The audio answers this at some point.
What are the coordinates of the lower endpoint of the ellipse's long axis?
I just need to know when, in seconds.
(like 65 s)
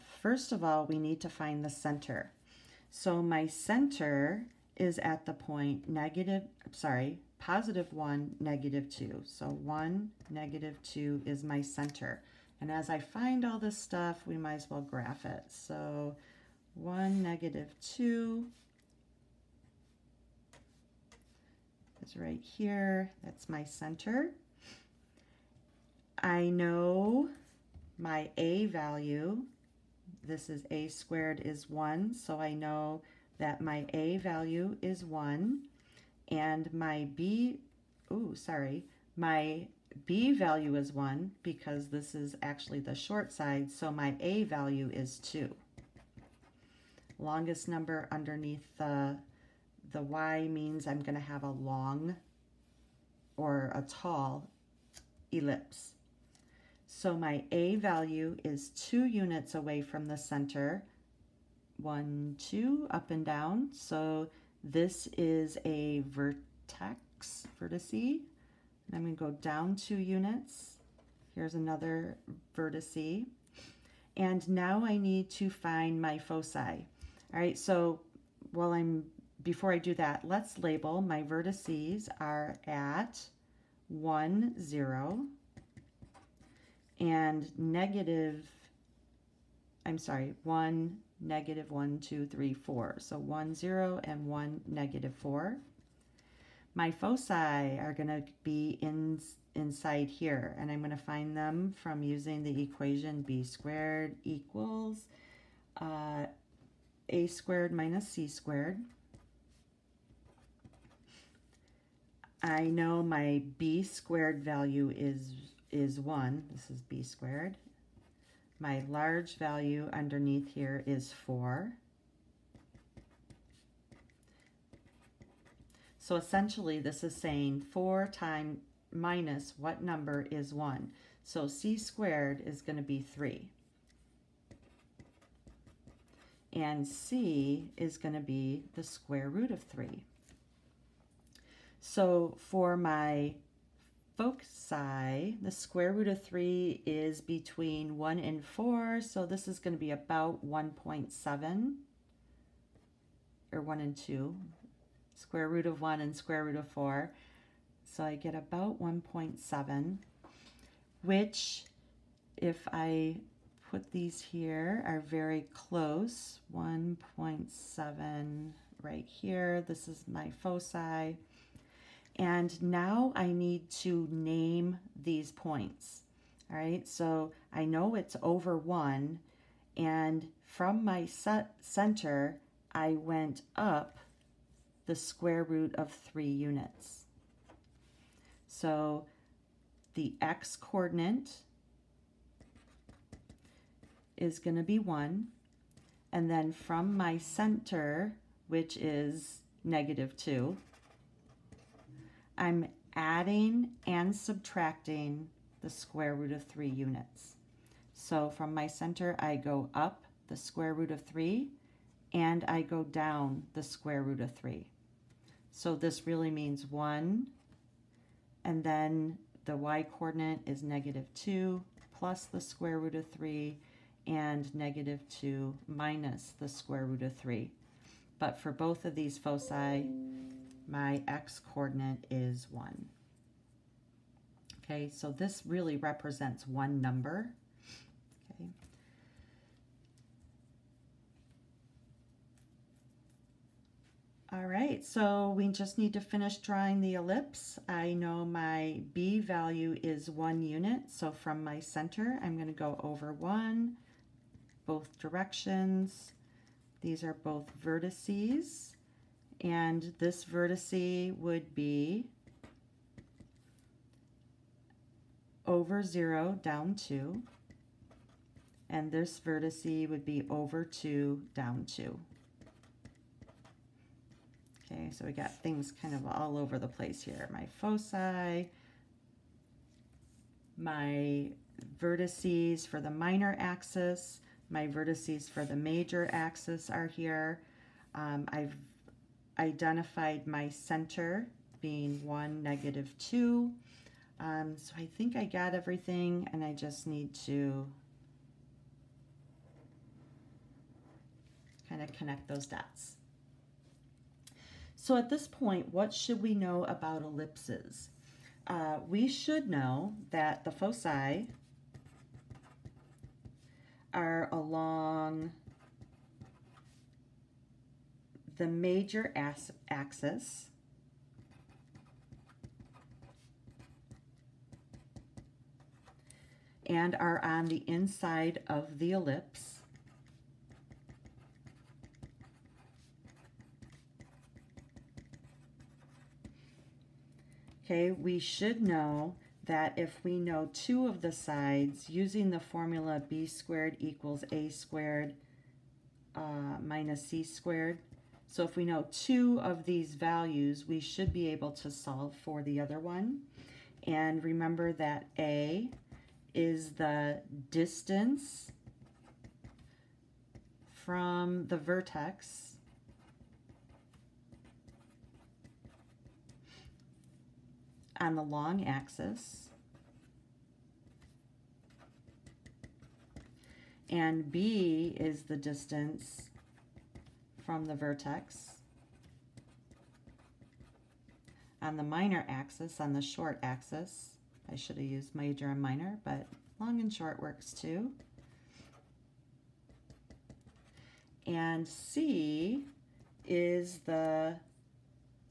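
94 s.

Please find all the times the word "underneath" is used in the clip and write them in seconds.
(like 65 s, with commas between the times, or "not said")
48 s, 119 s.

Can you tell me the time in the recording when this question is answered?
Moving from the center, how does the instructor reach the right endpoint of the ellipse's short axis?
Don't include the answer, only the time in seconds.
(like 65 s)
270 s.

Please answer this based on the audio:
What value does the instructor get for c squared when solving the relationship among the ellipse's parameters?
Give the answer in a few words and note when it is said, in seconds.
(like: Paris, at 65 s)
3, at 131 s.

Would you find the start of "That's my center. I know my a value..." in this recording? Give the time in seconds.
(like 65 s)
23 s.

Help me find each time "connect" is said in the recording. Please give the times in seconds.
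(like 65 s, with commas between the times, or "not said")
301 s.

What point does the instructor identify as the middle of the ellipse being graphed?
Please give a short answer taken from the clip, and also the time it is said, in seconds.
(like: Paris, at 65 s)
(1, -2), at 7 s.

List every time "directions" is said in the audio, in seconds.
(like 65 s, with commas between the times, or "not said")
254 s.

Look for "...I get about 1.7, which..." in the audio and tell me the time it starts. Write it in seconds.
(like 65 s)
158 s.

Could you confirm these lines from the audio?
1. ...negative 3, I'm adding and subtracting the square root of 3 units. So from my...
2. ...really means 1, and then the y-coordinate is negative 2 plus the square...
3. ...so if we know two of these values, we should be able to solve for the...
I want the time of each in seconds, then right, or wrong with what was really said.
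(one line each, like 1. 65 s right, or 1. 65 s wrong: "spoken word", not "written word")
1. 199 s wrong: "2", not "3"
2. 216 s right
3. 348 s right.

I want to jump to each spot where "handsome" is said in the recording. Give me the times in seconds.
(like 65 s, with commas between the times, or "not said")
not said.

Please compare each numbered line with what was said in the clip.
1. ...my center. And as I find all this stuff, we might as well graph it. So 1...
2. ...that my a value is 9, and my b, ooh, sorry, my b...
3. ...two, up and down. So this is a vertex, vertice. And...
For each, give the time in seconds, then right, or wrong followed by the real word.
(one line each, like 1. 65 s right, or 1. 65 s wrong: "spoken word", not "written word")
1. 11 s right
2. 33 s wrong: "1", not "9"
3. 62 s right.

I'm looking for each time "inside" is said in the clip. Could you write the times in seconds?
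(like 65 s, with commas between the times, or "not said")
99 s, 327 s.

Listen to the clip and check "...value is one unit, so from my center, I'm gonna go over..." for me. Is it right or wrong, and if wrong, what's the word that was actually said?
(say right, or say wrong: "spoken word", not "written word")
right.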